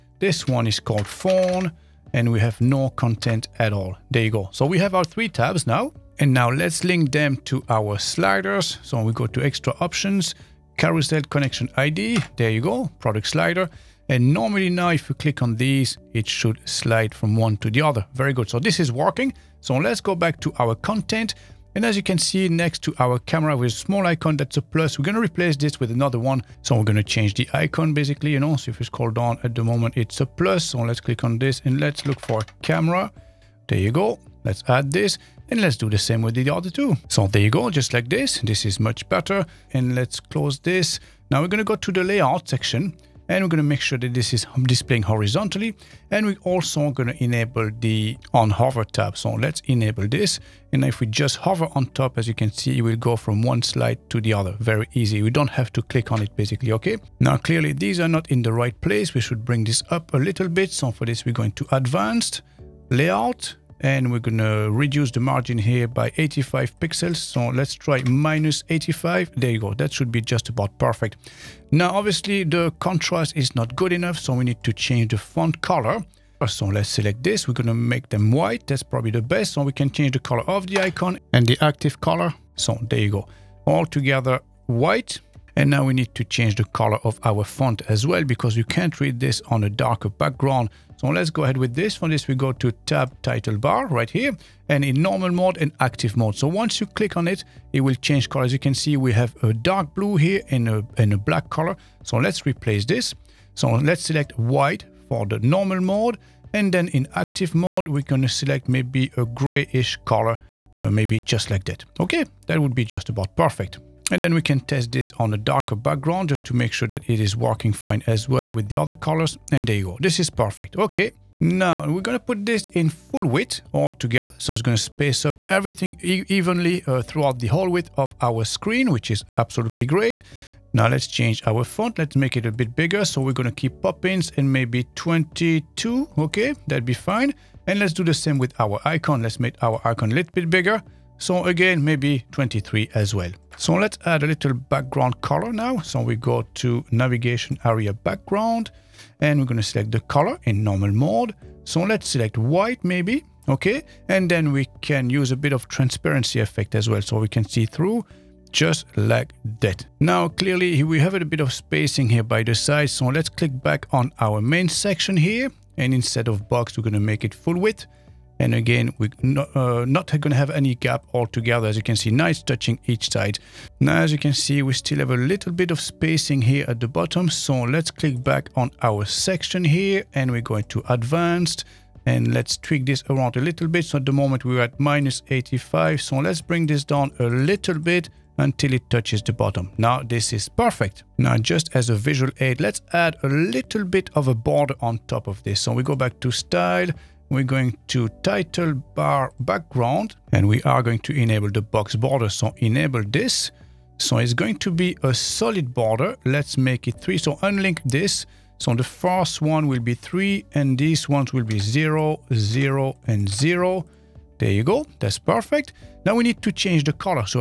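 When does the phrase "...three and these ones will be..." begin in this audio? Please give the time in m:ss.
3:29.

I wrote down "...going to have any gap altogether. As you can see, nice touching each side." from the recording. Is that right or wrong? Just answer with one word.
right.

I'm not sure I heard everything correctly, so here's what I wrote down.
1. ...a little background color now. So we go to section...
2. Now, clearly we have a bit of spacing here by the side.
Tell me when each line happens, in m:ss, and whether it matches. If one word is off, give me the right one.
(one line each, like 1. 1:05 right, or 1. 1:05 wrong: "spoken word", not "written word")
1. 2:24 wrong: "navigation", not "section"
2. 2:39 right.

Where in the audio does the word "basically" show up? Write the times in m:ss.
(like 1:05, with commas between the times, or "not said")
0:27, 0:56.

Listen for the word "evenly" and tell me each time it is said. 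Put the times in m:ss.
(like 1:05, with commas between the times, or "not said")
2:06.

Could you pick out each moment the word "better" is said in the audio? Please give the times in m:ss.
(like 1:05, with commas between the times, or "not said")
0:39.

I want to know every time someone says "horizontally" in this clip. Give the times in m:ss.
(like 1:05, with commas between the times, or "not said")
0:45.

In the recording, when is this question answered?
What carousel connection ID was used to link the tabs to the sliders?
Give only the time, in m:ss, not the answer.
0:12.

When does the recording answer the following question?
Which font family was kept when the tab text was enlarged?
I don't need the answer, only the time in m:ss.
2:13.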